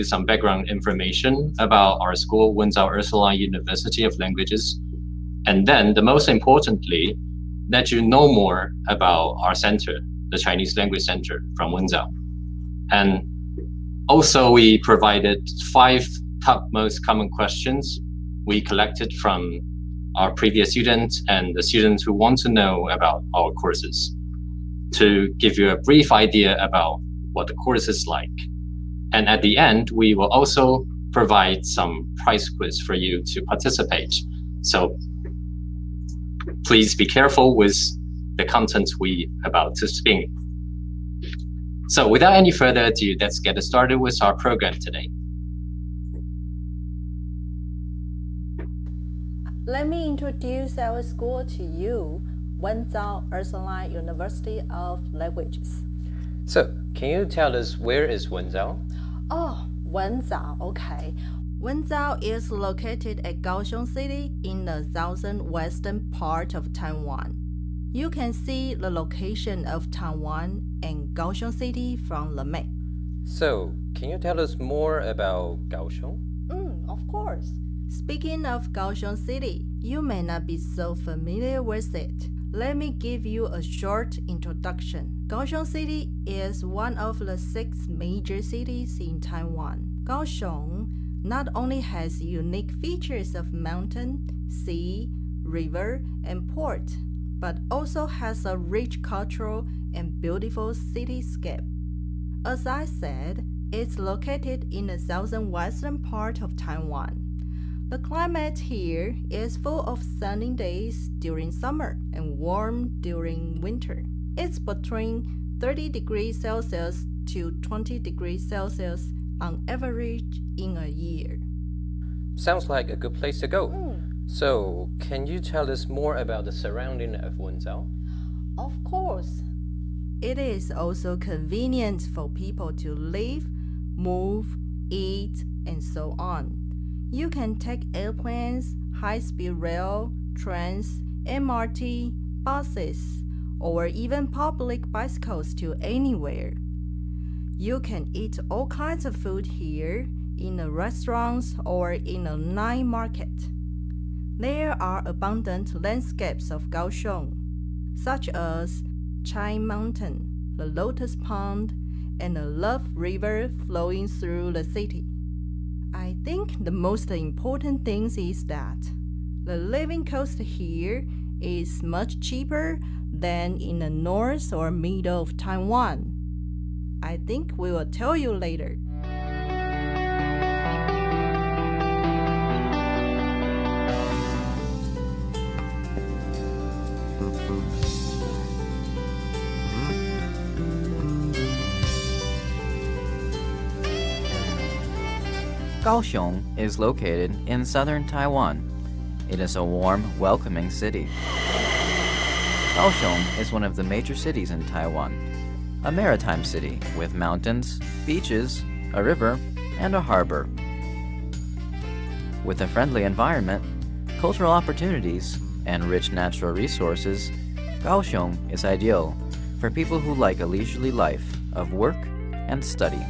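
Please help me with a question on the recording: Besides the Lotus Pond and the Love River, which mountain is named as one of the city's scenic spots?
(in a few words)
Chai Mountain.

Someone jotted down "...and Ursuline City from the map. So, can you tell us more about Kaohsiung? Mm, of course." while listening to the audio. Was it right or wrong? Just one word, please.
wrong.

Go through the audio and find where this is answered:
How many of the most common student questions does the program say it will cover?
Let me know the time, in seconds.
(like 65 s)
15 s.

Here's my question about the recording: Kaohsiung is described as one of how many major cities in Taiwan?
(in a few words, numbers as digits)
6.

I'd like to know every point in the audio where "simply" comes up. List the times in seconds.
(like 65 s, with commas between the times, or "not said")
not said.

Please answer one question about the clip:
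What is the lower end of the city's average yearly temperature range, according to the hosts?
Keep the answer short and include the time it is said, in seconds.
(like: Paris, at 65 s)
20 degrees Celsius, at 117 s.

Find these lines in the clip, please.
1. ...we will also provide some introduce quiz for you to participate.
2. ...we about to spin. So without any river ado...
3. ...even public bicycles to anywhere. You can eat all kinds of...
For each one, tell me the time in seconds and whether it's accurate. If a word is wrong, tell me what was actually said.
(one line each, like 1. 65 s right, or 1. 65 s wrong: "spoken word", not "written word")
1. 29 s wrong: "price", not "introduce"
2. 38 s wrong: "further", not "river"
3. 143 s right.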